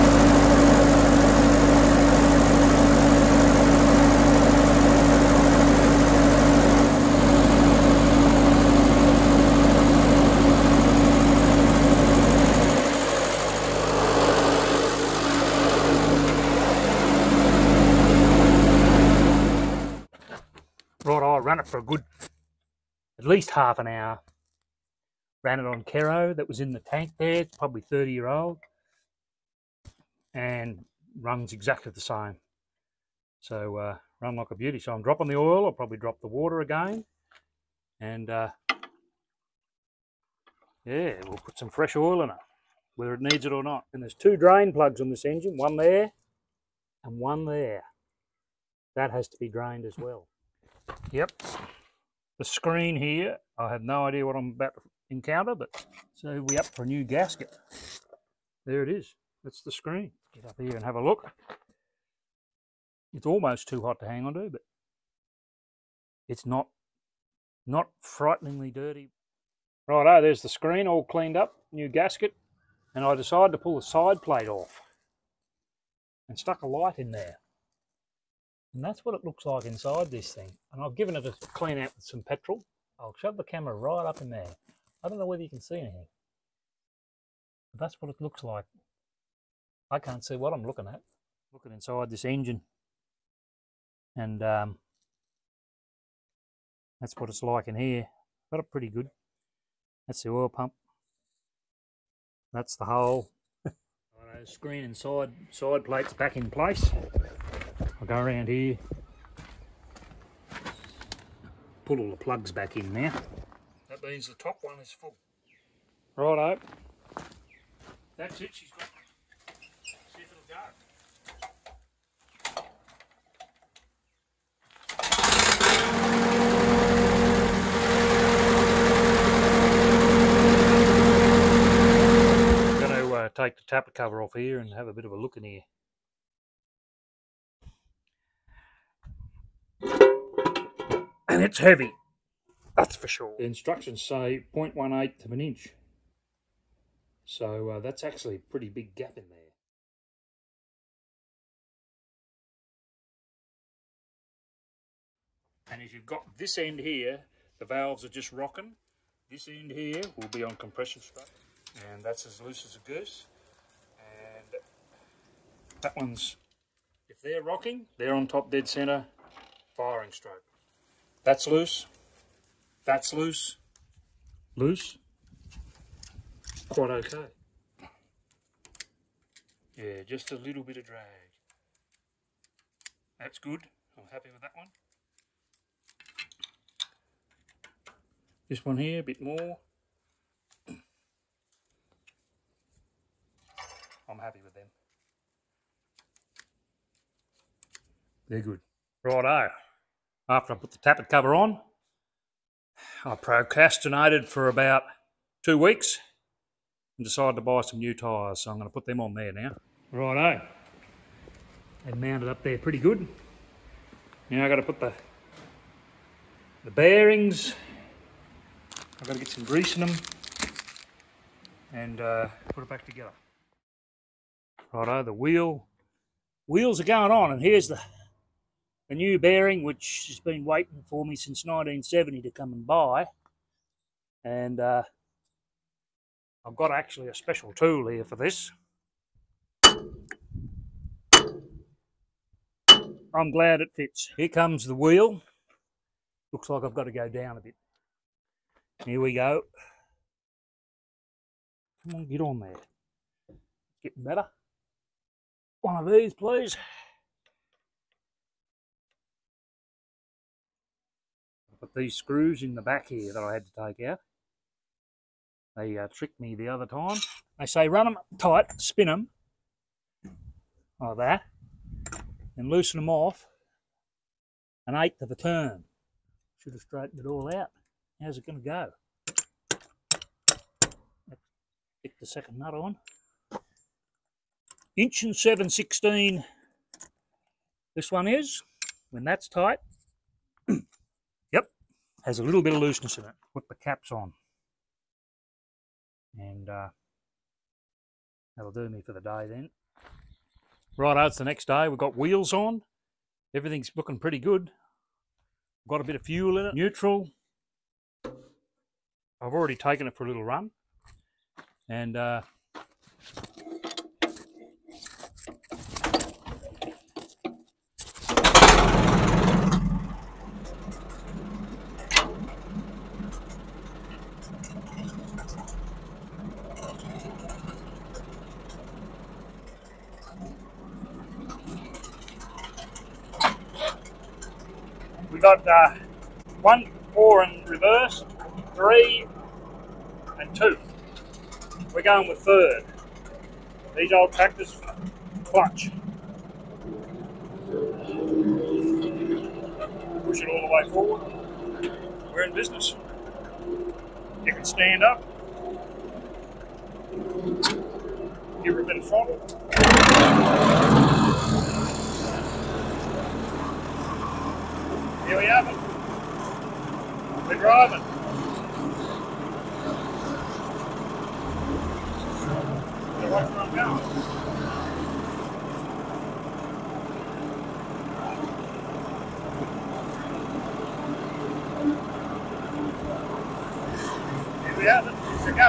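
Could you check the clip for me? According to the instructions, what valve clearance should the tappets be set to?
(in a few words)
0.18 of an inch.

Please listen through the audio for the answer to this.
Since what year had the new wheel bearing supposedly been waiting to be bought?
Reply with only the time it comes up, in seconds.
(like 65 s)
231 s.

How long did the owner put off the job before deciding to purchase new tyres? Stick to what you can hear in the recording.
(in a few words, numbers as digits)
two weeks.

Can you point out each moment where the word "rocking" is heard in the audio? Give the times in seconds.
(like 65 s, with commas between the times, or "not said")
158 s, 167 s.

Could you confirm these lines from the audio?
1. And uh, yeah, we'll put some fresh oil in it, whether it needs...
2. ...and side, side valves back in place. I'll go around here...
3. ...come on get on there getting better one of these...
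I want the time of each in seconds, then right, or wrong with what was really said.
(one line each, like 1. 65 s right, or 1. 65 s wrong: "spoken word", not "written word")
1. 38 s right
2. 104 s wrong: "plates", not "valves"
3. 251 s right.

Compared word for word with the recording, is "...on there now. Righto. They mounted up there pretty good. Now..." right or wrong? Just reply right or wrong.
right.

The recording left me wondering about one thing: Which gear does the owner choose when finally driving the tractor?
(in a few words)
third.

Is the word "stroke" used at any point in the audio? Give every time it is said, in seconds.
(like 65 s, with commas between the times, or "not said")
161 s, 170 s.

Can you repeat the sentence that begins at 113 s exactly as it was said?
That means the top one is full.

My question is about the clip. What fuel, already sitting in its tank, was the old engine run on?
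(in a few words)
Kero.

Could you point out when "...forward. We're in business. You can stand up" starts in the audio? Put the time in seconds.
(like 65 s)
350 s.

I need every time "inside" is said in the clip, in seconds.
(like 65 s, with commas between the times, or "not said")
79 s, 91 s.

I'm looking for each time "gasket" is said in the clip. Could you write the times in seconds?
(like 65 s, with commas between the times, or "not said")
57 s, 71 s.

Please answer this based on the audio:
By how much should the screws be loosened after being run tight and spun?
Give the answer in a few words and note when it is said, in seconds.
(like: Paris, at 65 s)
an eighth of a turn, at 274 s.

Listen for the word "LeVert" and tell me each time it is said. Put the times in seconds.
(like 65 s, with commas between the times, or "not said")
not said.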